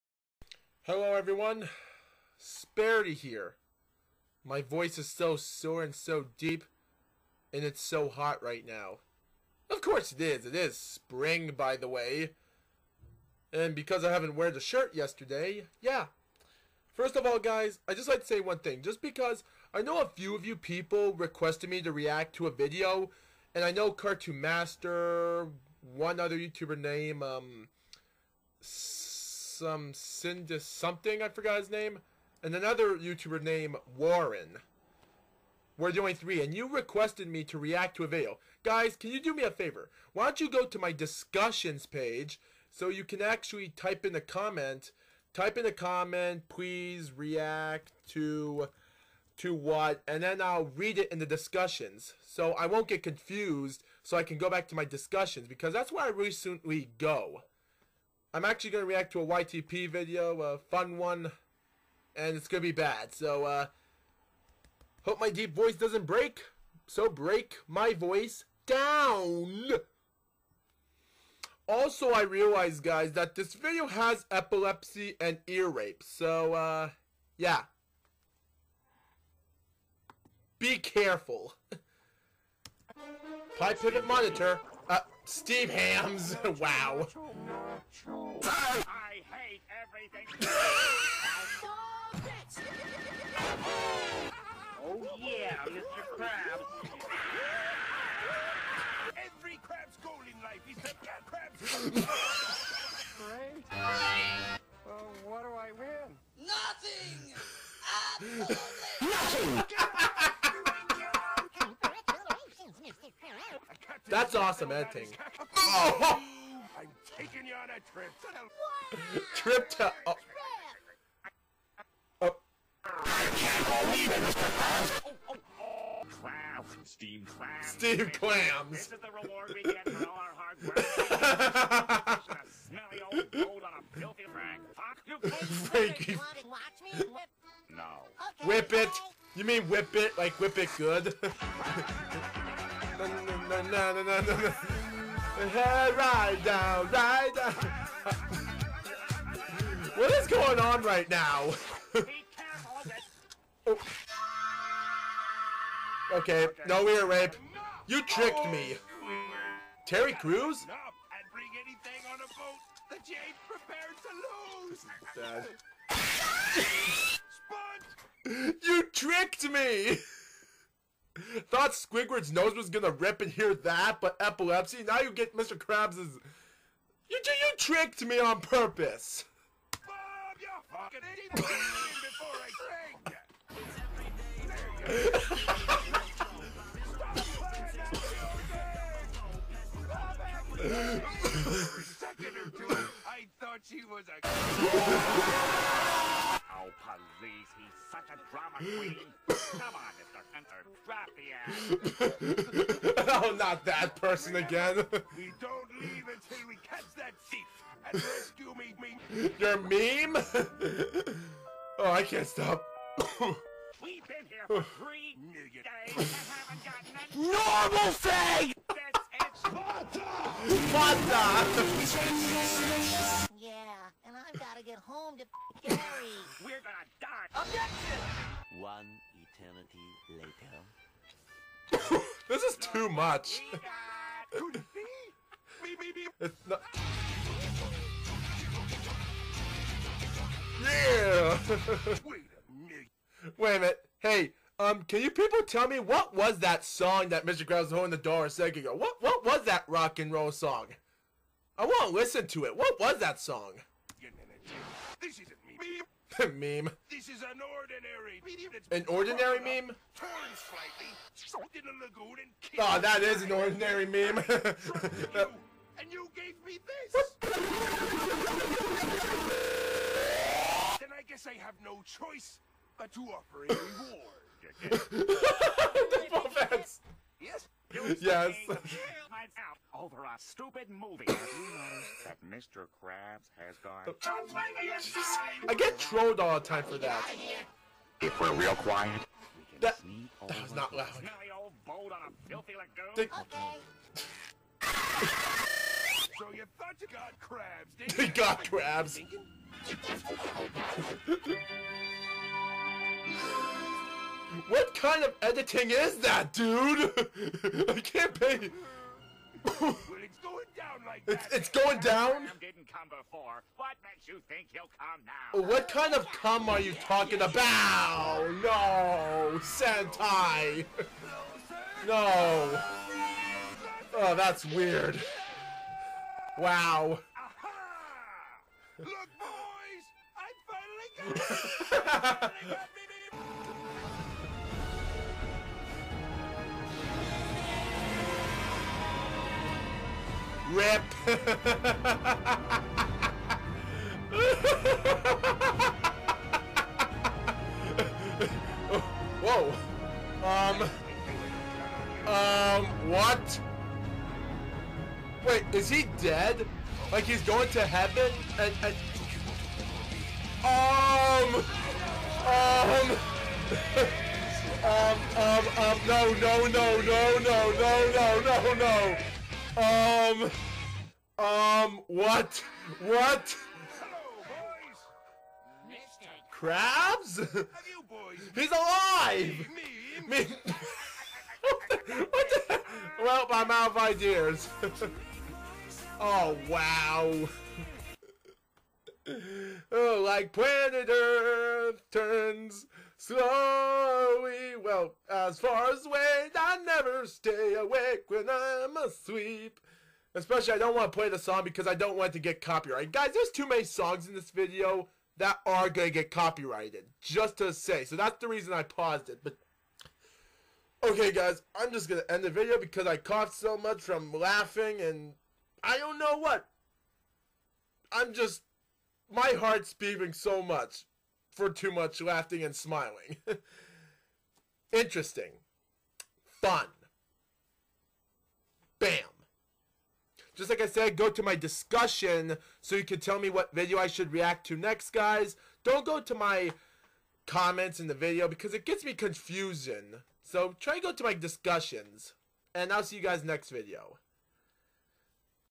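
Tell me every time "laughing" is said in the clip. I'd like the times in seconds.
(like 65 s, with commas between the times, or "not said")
414 s, 422 s.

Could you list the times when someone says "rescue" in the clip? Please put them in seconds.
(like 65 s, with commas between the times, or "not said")
207 s.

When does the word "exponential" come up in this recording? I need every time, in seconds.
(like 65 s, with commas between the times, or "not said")
not said.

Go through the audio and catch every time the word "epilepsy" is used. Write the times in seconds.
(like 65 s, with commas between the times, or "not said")
74 s, 174 s.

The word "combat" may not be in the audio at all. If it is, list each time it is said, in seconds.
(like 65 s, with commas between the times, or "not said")
not said.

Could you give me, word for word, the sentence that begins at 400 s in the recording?
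Especially, I don't want to play the song because I don't want to get copyrighted.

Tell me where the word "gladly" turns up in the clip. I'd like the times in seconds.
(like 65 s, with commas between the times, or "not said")
not said.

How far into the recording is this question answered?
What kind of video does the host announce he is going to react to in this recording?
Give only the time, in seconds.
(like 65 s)
59 s.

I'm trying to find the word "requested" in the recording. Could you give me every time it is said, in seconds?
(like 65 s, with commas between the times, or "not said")
21 s, 36 s.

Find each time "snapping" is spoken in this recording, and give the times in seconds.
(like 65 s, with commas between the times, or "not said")
not said.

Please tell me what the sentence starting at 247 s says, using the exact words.
Krabs was holding the door a second ago?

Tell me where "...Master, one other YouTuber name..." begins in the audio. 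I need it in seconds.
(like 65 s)
24 s.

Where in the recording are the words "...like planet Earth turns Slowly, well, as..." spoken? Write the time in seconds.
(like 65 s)
390 s.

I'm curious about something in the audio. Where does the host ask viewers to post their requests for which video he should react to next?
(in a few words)
discussions page.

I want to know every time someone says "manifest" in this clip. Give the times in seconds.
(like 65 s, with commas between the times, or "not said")
not said.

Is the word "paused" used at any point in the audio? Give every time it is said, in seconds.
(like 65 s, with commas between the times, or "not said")
408 s.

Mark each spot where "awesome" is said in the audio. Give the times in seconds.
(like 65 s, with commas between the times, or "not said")
114 s.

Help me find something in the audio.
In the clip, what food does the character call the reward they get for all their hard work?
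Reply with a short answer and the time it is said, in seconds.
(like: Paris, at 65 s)
Steam clams, at 126 s.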